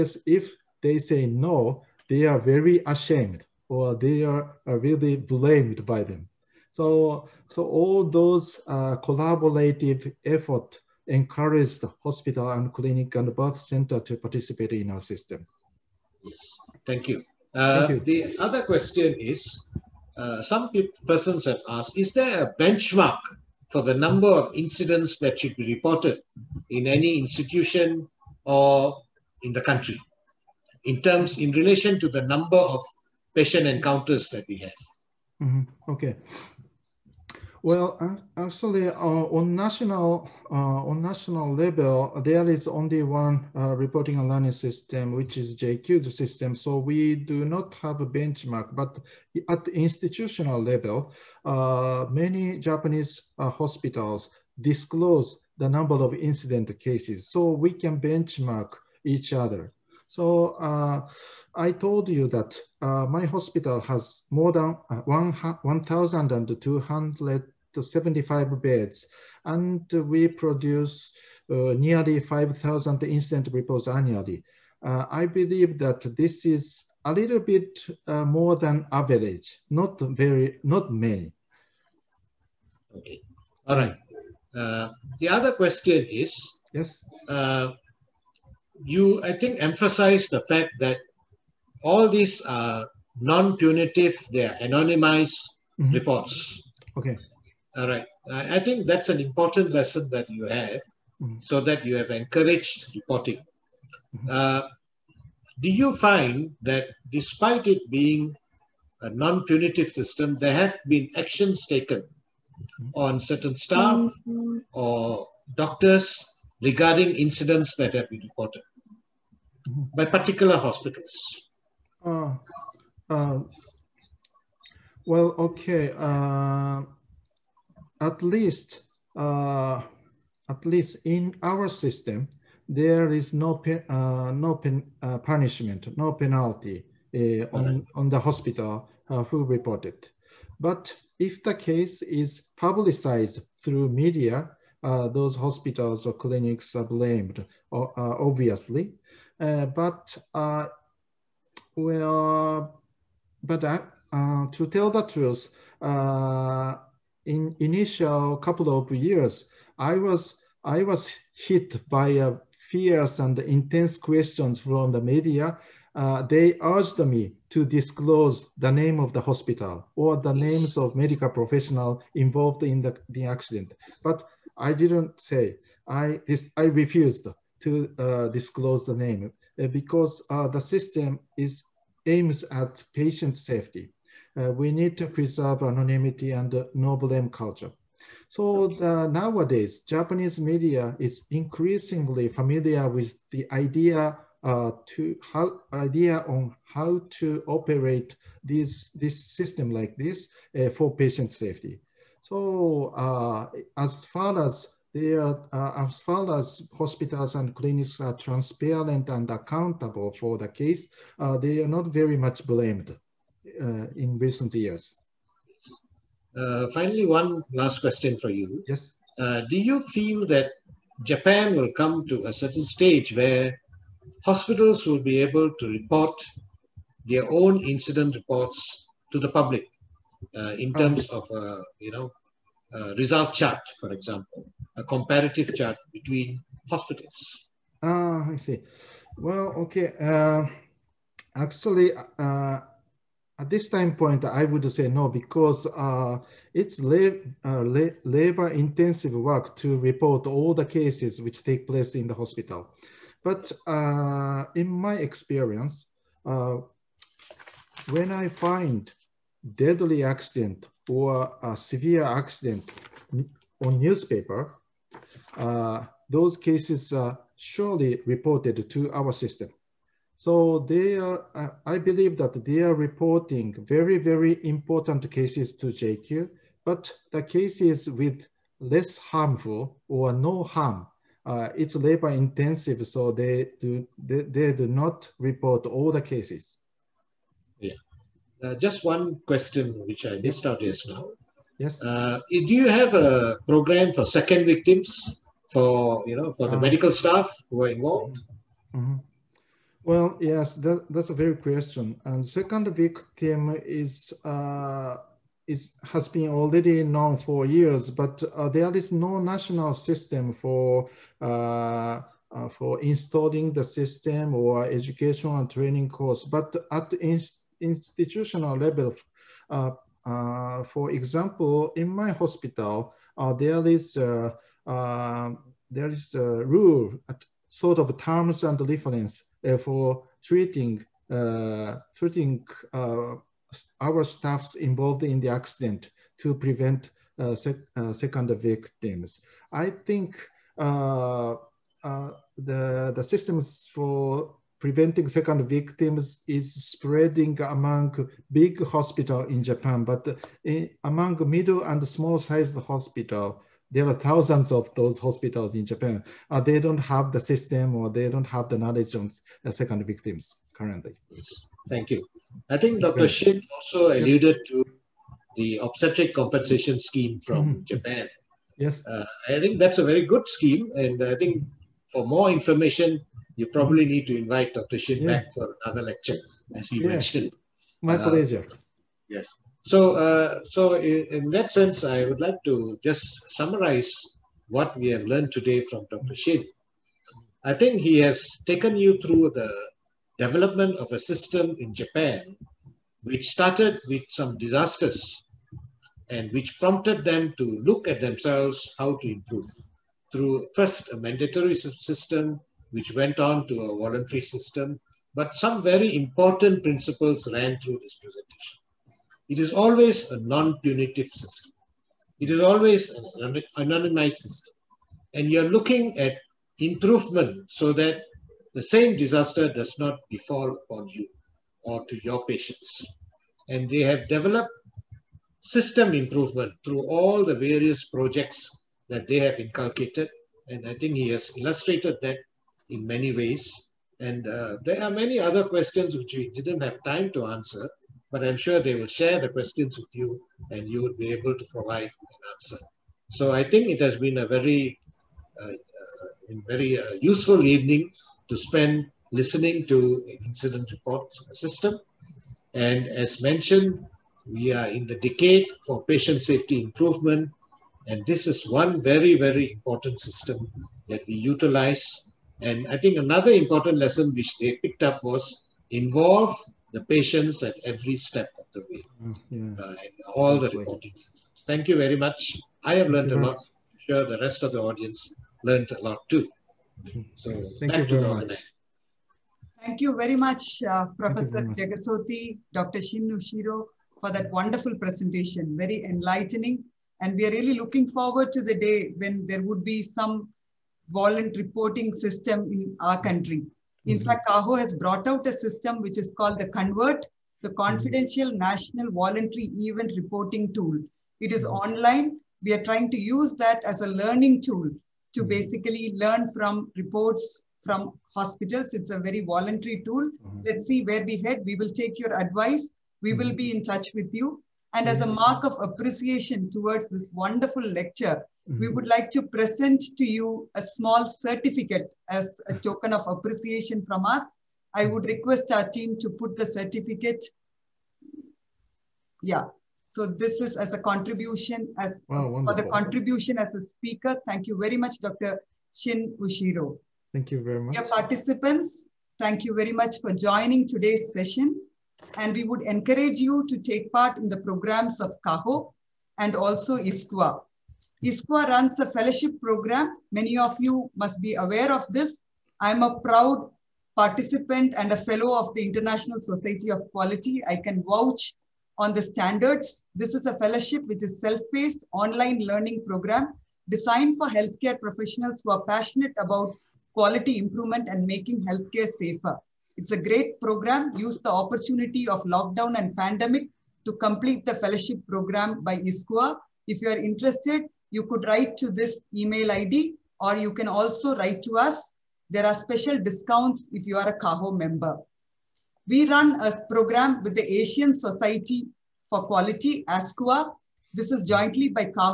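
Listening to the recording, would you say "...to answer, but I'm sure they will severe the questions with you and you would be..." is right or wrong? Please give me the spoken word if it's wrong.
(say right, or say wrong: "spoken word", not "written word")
wrong: "share", not "severe".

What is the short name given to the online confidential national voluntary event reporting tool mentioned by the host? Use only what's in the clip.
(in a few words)
Convert.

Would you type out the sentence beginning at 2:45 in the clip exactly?
Uh, they urged me to disclose the name of the hospital or the names of medical professional involved in the, the accident.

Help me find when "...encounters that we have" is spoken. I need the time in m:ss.
0:33.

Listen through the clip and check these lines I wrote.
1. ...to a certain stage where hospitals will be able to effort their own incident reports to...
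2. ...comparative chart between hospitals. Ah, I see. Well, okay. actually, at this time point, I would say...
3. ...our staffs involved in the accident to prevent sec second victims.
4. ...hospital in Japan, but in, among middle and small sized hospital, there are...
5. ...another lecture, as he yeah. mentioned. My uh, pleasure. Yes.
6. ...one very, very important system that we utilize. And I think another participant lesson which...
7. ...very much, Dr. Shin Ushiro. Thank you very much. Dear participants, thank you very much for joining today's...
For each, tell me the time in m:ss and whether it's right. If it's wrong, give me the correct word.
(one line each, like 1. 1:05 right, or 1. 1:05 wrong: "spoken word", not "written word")
1. 3:42 wrong: "report", not "effort"
2. 3:54 right
3. 5:33 right
4. 5:48 right
5. 6:15 right
6. 7:38 wrong: "important", not "participant"
7. 8:54 right.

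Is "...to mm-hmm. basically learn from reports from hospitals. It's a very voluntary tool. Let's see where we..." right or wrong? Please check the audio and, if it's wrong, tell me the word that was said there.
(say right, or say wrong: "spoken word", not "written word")
right.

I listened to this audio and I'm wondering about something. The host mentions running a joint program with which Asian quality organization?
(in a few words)
Asian Society for Quality.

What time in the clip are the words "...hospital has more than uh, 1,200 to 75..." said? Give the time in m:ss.
1:03.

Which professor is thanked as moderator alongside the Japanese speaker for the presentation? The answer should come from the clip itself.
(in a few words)
Jegasothy.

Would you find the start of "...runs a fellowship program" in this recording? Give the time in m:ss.
9:08.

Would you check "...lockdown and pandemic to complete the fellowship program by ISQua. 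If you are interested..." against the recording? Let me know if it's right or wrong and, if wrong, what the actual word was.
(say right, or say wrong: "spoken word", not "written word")
right.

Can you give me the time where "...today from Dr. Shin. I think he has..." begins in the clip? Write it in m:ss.
6:25.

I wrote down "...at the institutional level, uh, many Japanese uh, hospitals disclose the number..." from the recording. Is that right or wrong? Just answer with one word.
right.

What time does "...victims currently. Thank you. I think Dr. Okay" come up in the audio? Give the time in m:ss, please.
5:59.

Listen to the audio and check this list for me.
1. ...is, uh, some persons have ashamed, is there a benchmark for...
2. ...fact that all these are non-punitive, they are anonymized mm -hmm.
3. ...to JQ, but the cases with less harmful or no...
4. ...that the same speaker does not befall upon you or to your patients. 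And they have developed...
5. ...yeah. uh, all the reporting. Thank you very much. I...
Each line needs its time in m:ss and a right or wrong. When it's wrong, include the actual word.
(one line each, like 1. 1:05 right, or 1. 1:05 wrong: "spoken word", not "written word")
1. 0:19 wrong: "asked", not "ashamed"
2. 1:30 right
3. 4:35 right
4. 6:57 wrong: "disaster", not "speaker"
5. 7:49 right.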